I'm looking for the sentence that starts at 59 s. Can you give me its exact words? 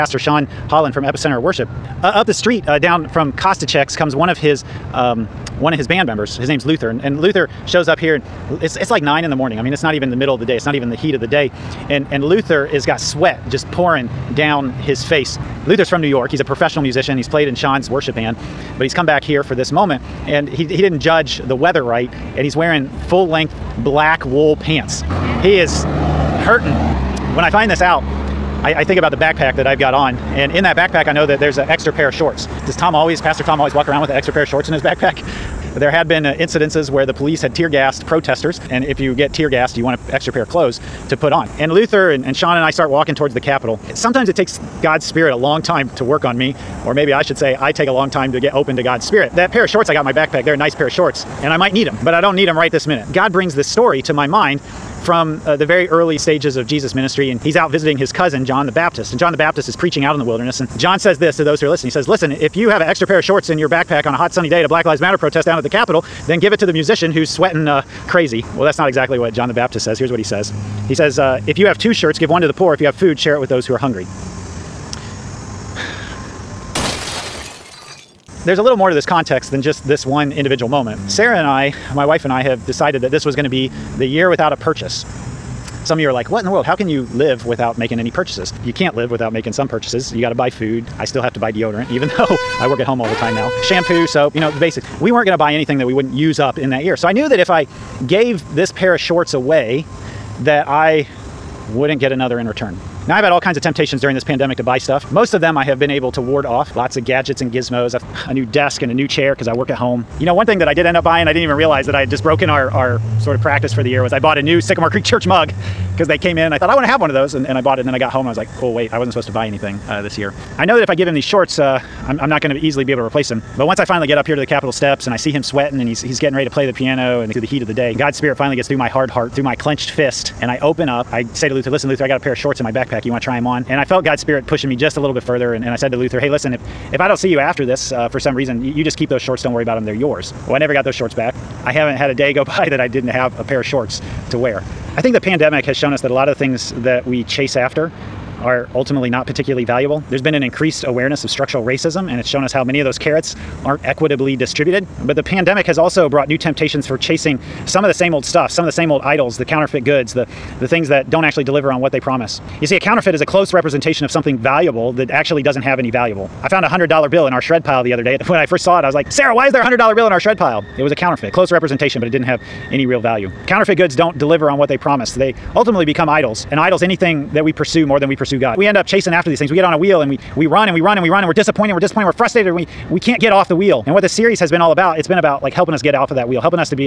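And John the Baptist is preaching out in the wilderness.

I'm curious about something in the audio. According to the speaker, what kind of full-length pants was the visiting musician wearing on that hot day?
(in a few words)
Black wool pants.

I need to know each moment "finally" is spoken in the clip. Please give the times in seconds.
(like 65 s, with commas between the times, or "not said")
123 s, 128 s.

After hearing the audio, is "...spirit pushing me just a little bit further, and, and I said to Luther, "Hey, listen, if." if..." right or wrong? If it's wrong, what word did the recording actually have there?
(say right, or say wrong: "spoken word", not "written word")
right.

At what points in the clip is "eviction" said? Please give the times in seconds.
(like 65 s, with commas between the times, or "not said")
not said.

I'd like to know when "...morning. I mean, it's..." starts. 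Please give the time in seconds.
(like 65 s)
9 s.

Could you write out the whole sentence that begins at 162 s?
You see, a counterfeit is a close representation of something valuable that actually doesn't have any valuable.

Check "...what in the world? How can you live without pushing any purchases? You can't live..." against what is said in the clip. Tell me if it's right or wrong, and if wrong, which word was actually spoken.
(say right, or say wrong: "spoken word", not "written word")
wrong: "making", not "pushing".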